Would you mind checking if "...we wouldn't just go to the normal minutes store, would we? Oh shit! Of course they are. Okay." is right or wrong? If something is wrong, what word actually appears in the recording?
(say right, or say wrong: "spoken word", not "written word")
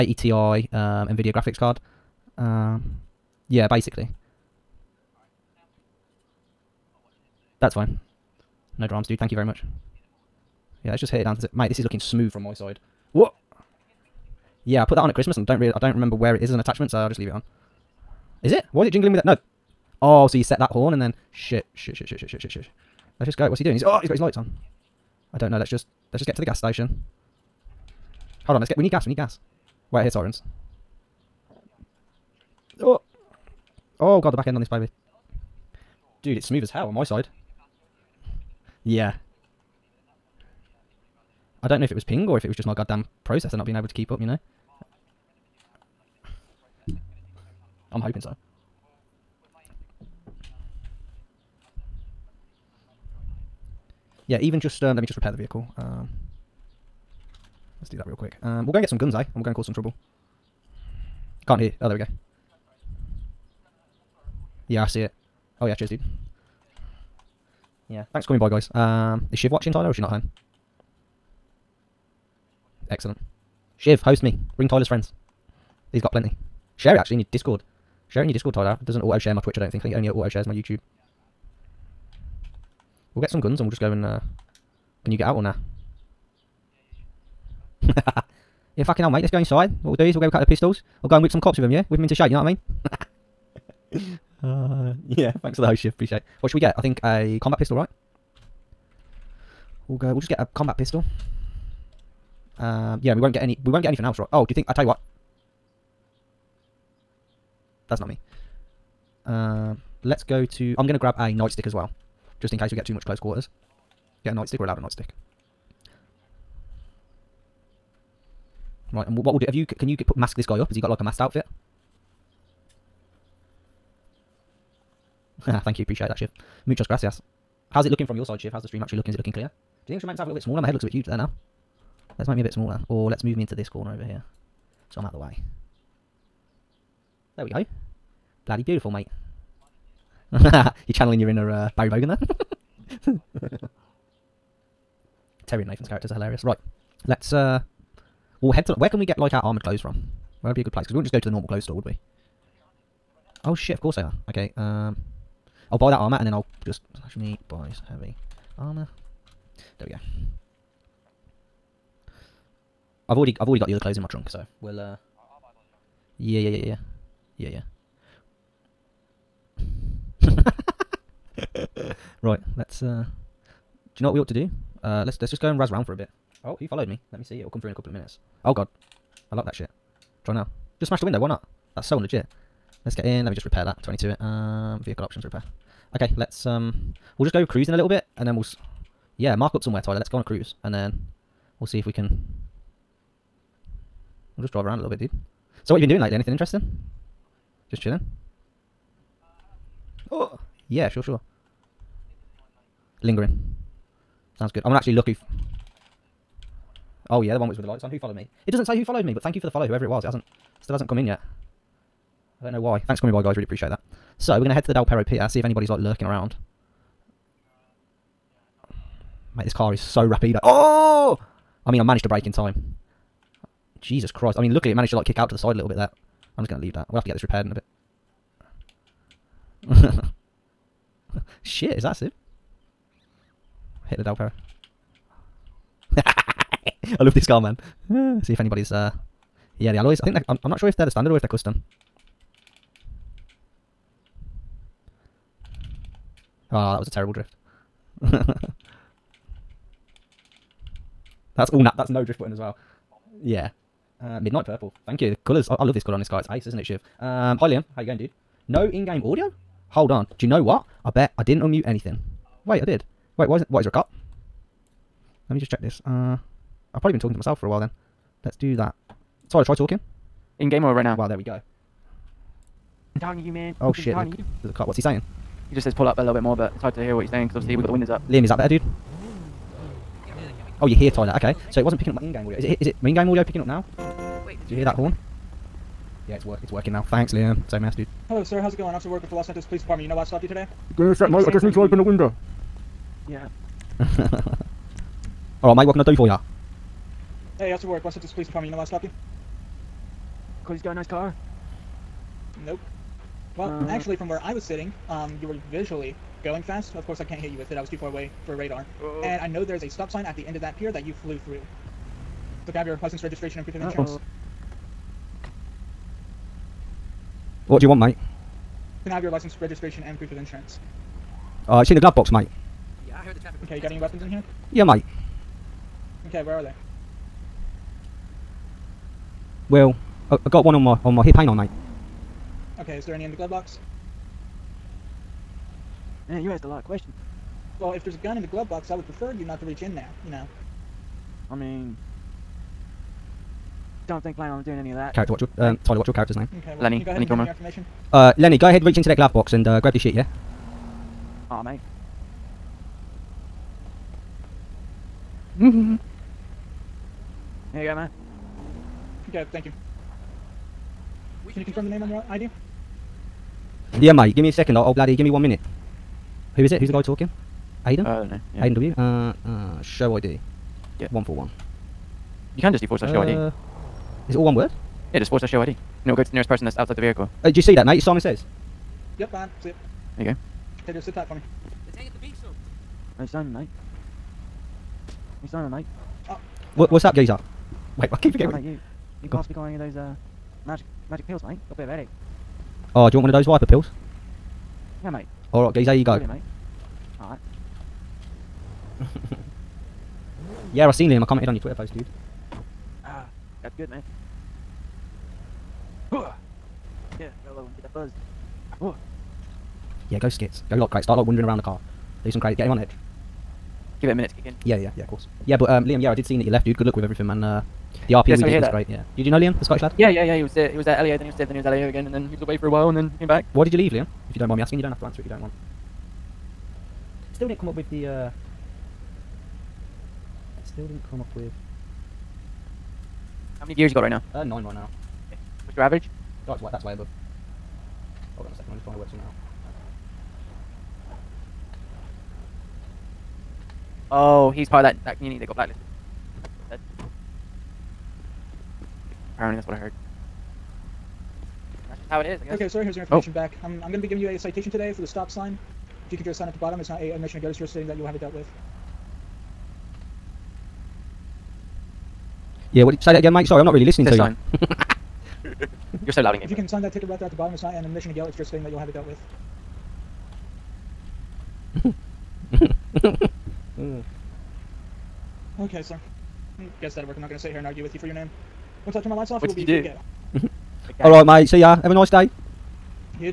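wrong: "clothes", not "minutes".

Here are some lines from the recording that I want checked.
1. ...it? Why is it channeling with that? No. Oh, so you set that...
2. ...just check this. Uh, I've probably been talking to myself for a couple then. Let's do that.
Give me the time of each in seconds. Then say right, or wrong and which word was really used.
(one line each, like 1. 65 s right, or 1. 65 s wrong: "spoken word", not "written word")
1. 18 s wrong: "jingling", not "channeling"
2. 265 s wrong: "while", not "couple".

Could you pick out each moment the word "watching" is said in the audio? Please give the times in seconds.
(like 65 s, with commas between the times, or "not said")
69 s.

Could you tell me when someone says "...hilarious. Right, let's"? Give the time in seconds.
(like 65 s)
146 s.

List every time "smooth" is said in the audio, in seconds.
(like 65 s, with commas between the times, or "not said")
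11 s, 36 s.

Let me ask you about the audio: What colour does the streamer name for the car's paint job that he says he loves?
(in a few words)
Midnight purple.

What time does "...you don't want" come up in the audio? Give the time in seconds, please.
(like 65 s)
425 s.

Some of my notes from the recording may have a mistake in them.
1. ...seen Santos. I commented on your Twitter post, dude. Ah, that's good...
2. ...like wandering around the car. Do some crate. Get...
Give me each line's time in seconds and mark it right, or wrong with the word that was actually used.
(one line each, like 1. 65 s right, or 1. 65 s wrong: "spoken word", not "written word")
1. 400 s wrong: "Liam", not "Santos"
2. 410 s right.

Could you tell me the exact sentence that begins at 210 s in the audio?
It hasn't, still hasn't come in yet.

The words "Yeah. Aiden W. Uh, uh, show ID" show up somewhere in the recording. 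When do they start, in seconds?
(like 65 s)
368 s.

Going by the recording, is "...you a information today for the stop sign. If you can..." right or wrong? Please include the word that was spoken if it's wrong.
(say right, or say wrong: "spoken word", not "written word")
wrong: "citation", not "information".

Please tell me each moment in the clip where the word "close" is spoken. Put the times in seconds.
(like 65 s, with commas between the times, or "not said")
113 s.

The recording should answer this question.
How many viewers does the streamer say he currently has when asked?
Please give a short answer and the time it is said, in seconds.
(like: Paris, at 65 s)
9, at 434 s.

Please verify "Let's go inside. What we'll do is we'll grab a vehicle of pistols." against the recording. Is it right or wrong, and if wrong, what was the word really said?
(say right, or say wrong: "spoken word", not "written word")
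wrong: "couple", not "vehicle".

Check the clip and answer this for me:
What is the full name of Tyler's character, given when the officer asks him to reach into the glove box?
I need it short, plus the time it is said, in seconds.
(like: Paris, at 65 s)
Lenny Kilmer, at 346 s.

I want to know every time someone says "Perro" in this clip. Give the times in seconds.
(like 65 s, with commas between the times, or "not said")
214 s, 234 s.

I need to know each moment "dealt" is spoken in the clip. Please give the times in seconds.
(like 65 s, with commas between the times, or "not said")
458 s, 468 s.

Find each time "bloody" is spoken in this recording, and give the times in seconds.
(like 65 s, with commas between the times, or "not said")
138 s, 364 s.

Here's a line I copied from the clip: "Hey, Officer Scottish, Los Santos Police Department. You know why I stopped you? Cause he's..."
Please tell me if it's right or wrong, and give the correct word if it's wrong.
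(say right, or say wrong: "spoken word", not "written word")
wrong: "Work", not "Scottish".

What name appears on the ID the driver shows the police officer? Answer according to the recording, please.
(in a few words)
Simon Saiz.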